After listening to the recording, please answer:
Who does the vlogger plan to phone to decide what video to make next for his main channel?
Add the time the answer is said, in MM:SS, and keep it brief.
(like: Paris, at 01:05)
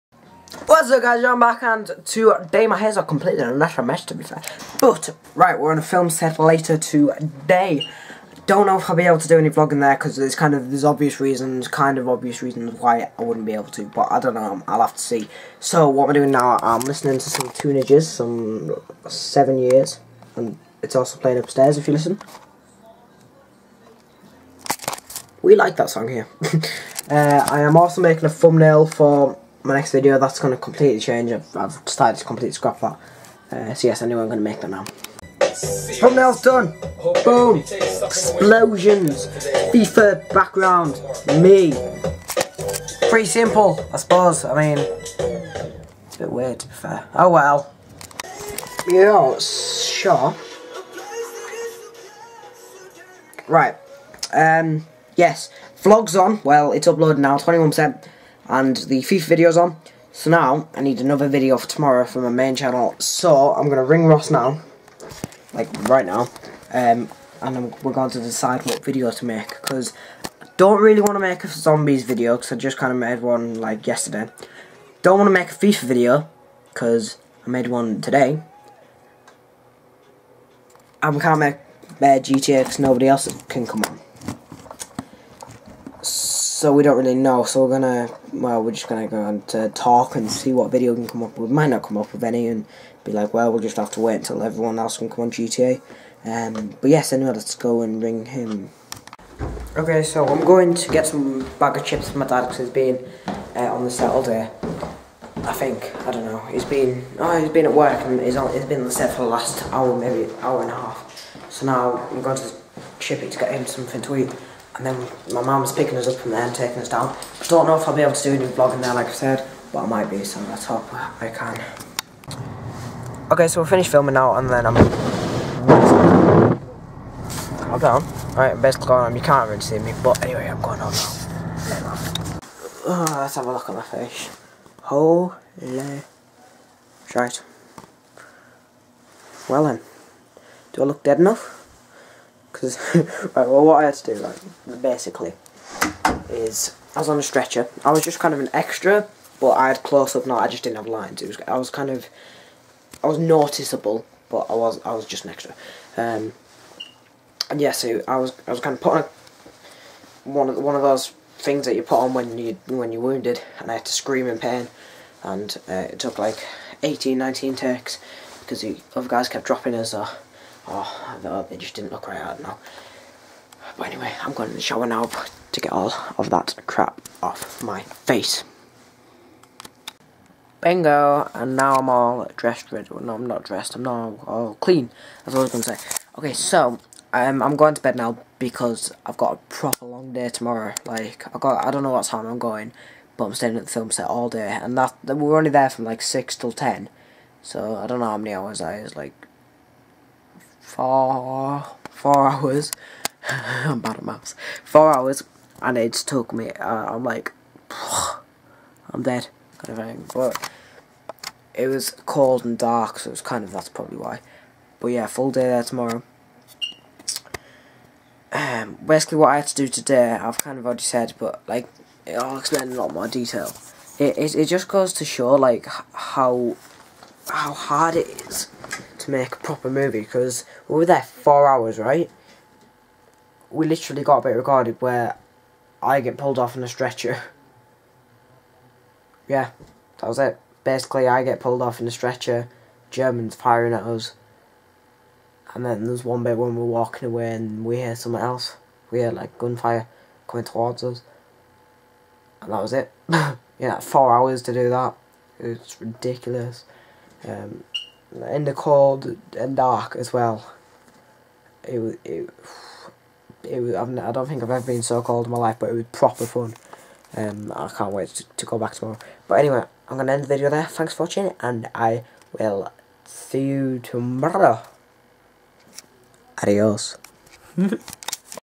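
Ross, at 01:04.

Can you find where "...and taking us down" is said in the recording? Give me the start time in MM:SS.
01:56.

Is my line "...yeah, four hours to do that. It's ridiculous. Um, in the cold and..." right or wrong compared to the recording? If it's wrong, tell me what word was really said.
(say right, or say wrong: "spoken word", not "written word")
right.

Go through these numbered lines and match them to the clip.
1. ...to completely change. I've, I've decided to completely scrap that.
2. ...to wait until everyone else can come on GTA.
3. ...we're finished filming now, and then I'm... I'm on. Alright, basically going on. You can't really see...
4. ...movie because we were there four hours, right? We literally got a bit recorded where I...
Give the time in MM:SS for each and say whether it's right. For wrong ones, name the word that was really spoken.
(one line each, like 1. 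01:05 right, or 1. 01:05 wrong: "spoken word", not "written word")
1. 00:30 right
2. 01:33 right
3. 02:03 right
4. 03:49 right.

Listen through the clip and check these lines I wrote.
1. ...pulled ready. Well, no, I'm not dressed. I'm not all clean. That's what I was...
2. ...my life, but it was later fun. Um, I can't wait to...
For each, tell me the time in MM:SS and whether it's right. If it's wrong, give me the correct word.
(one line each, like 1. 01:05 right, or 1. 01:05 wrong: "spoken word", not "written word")
1. 03:02 wrong: "dressed", not "pulled"
2. 04:25 wrong: "proper", not "later".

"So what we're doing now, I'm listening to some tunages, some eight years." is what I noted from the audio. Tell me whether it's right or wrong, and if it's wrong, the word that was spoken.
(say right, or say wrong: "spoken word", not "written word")
wrong: "seven", not "eight".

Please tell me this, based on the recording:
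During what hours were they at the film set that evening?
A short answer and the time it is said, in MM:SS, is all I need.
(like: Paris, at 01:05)
6 till 10, at 03:16.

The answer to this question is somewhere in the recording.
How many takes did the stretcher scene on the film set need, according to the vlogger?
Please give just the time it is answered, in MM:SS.
02:46.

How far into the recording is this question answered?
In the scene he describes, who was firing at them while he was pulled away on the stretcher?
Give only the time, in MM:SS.
04:02.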